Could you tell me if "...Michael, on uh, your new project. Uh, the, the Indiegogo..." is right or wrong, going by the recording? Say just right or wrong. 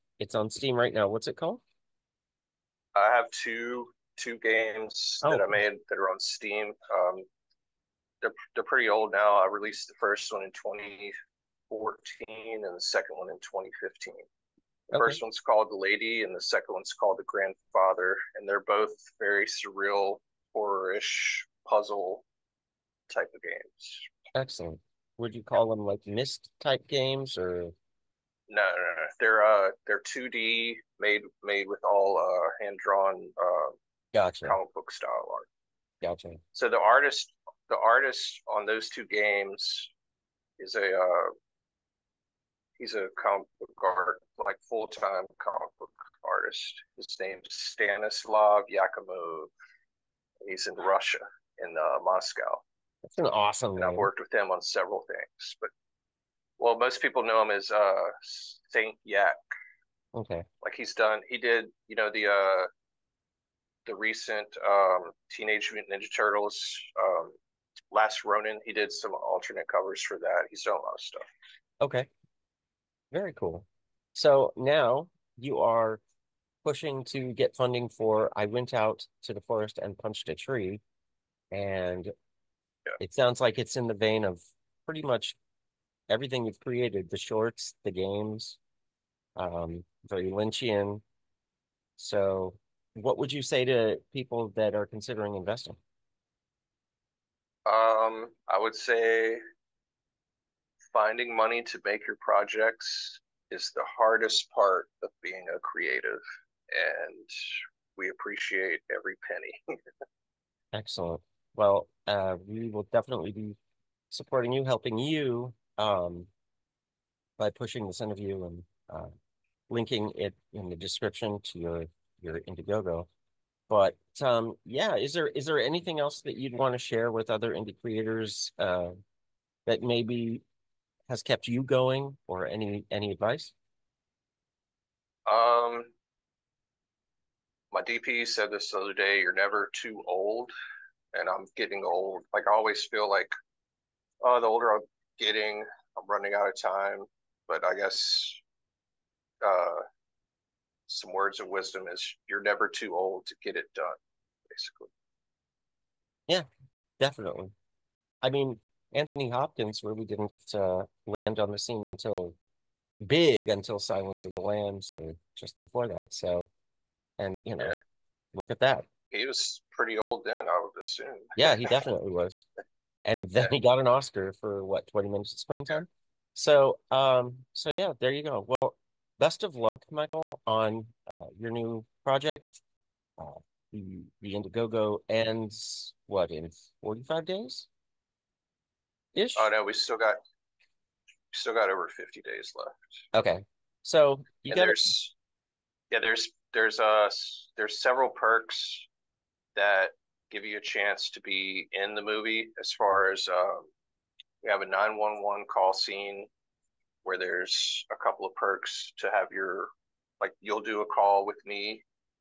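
right.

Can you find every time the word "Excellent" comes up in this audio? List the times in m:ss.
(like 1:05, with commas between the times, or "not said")
0:24, 1:50.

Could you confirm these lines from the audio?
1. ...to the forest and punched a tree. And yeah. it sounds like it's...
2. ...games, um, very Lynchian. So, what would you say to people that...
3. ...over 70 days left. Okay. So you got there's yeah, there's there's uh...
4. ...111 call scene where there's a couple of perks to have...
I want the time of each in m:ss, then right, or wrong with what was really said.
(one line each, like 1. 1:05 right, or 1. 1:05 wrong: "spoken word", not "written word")
1. 1:19 right
2. 1:27 right
3. 3:11 wrong: "50", not "70"
4. 3:24 wrong: "911", not "111".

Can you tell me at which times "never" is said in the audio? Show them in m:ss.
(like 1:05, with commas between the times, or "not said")
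2:19, 2:32.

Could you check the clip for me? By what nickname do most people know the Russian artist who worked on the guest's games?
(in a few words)
Saint Yak.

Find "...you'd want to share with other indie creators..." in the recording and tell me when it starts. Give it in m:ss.
2:06.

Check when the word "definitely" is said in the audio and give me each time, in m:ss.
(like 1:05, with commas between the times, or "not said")
1:52, 2:36, 2:51.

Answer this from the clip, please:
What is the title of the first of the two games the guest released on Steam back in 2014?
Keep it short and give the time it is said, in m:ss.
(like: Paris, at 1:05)
The Lady, at 0:15.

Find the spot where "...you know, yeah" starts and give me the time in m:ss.
2:47.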